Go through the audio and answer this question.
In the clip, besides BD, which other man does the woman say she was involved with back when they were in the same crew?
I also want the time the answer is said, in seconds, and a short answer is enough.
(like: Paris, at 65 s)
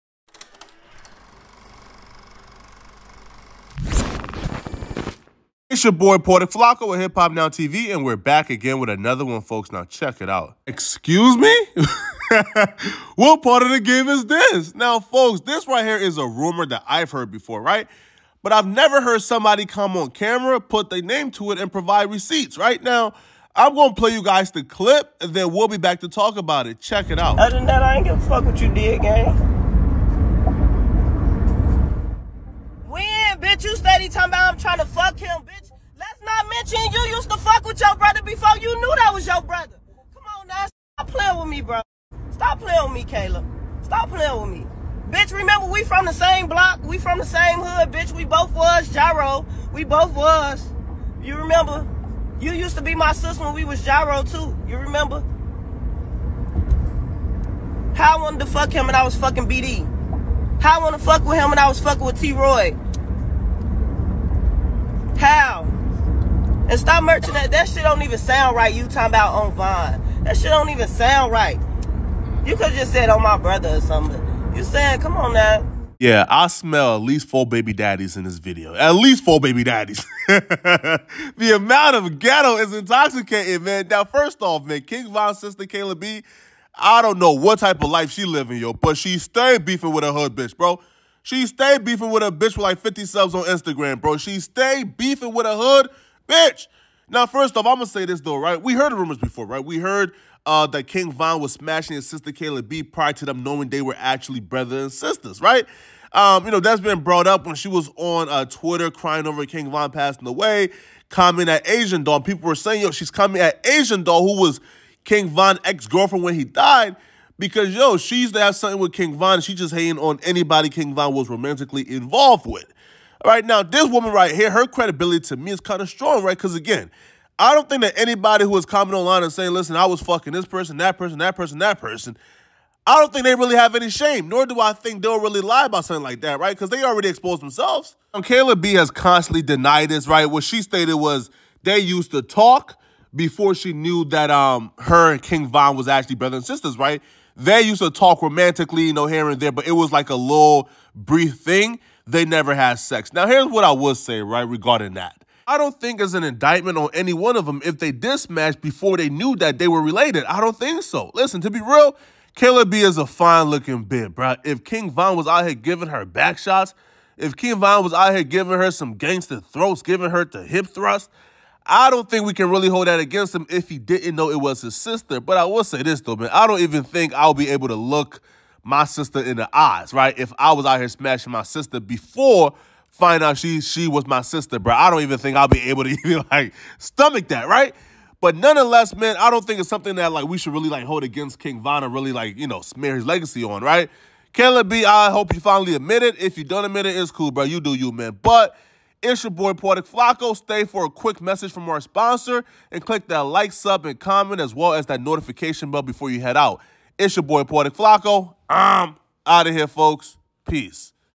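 T-Roy, at 62 s.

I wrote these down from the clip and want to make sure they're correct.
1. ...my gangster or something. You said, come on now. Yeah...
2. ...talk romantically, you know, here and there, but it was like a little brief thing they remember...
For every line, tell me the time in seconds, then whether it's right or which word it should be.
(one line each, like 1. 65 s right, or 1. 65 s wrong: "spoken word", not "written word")
1. 73 s wrong: "brother", not "gangster"
2. 147 s wrong: "never", not "remember".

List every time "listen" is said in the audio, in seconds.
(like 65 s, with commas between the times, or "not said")
129 s, 161 s.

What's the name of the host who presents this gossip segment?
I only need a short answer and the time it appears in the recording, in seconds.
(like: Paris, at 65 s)
Porter Flacco, at 6 s.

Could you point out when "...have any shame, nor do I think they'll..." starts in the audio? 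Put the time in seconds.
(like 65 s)
133 s.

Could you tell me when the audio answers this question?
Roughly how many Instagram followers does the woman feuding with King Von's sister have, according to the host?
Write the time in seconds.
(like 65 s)
92 s.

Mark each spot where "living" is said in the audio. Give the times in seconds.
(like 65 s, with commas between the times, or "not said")
88 s.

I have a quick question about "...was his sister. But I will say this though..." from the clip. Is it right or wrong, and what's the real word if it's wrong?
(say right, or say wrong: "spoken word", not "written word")
right.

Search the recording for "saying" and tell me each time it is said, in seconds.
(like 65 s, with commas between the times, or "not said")
112 s, 129 s.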